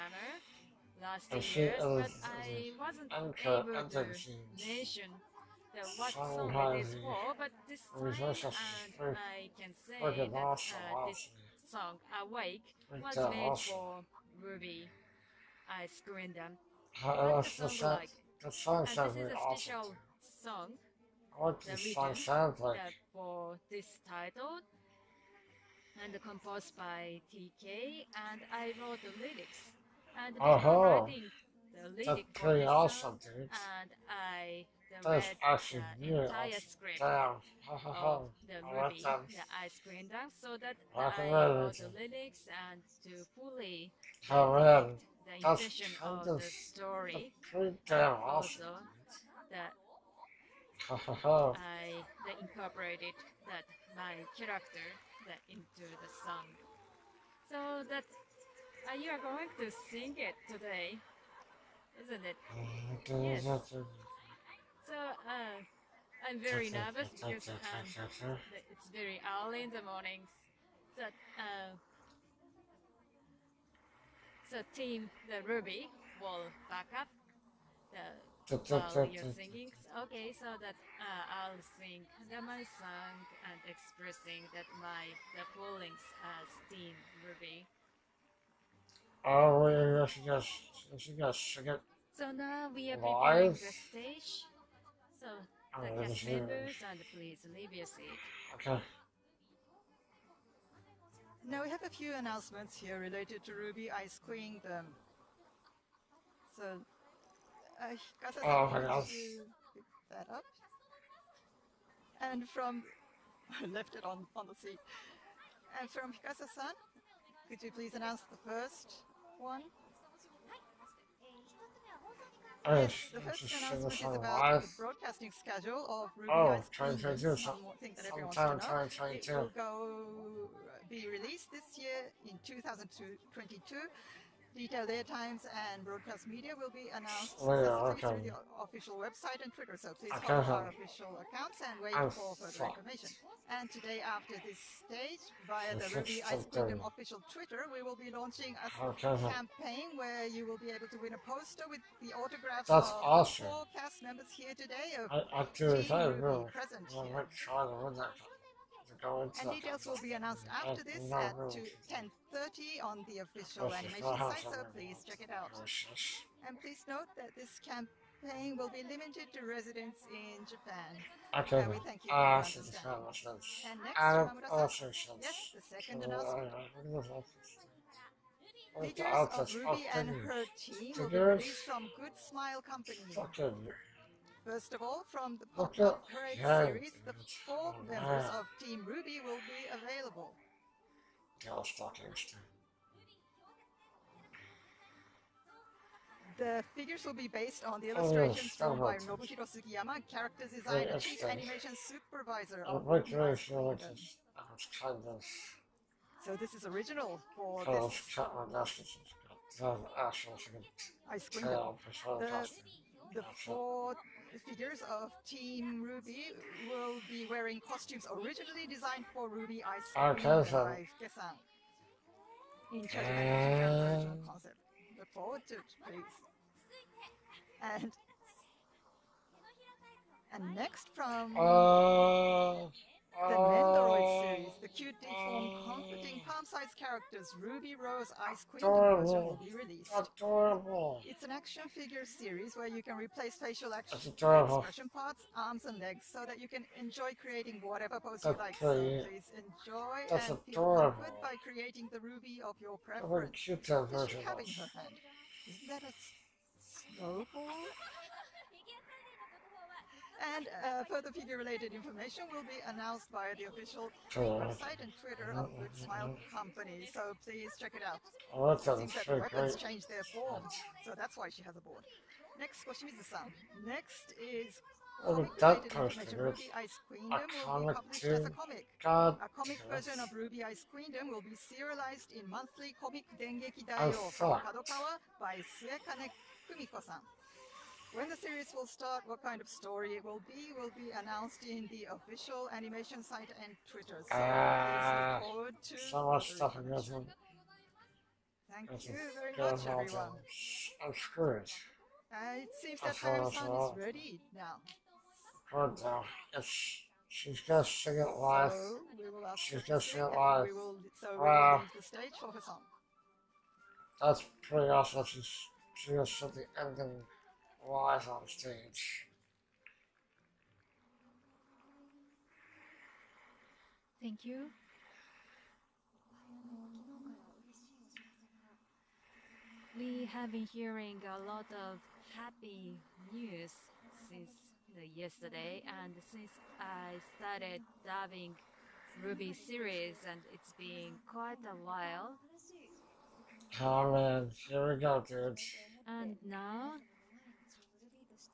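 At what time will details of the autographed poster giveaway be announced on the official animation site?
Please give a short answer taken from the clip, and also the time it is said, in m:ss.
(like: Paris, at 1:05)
10:30, at 2:41.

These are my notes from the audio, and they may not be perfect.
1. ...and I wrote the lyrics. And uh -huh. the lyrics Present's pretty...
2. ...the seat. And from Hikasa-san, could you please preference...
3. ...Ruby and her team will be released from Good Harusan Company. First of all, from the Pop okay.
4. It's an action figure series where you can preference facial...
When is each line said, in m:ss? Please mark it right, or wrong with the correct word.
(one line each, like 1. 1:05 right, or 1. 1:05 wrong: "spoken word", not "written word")
1. 0:28 wrong: "That", not "Present"
2. 1:54 wrong: "announce", not "preference"
3. 2:59 wrong: "Smile", not "Harusan"
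4. 4:01 wrong: "replace", not "preference".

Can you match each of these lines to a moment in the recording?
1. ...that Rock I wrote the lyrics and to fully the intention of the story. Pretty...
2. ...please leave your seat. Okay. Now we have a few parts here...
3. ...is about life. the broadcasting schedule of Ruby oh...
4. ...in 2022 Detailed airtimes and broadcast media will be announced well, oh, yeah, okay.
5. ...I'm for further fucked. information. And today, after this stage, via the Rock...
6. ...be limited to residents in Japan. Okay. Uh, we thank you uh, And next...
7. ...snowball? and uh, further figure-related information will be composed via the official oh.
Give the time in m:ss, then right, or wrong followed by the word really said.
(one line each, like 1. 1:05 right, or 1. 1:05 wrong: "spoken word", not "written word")
1. 0:40 right
2. 1:37 wrong: "announcements", not "parts"
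3. 2:03 right
4. 2:12 right
5. 2:21 wrong: "Ruby", not "Rock"
6. 2:48 right
7. 4:16 wrong: "announced", not "composed".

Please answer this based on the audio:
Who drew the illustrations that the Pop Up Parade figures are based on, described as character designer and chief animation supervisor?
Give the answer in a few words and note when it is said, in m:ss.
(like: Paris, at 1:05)
Nobuhiro Sugiyama, at 3:18.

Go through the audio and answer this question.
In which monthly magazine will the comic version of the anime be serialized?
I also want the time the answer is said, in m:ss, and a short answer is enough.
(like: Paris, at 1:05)
Dengeki Daioh, at 4:43.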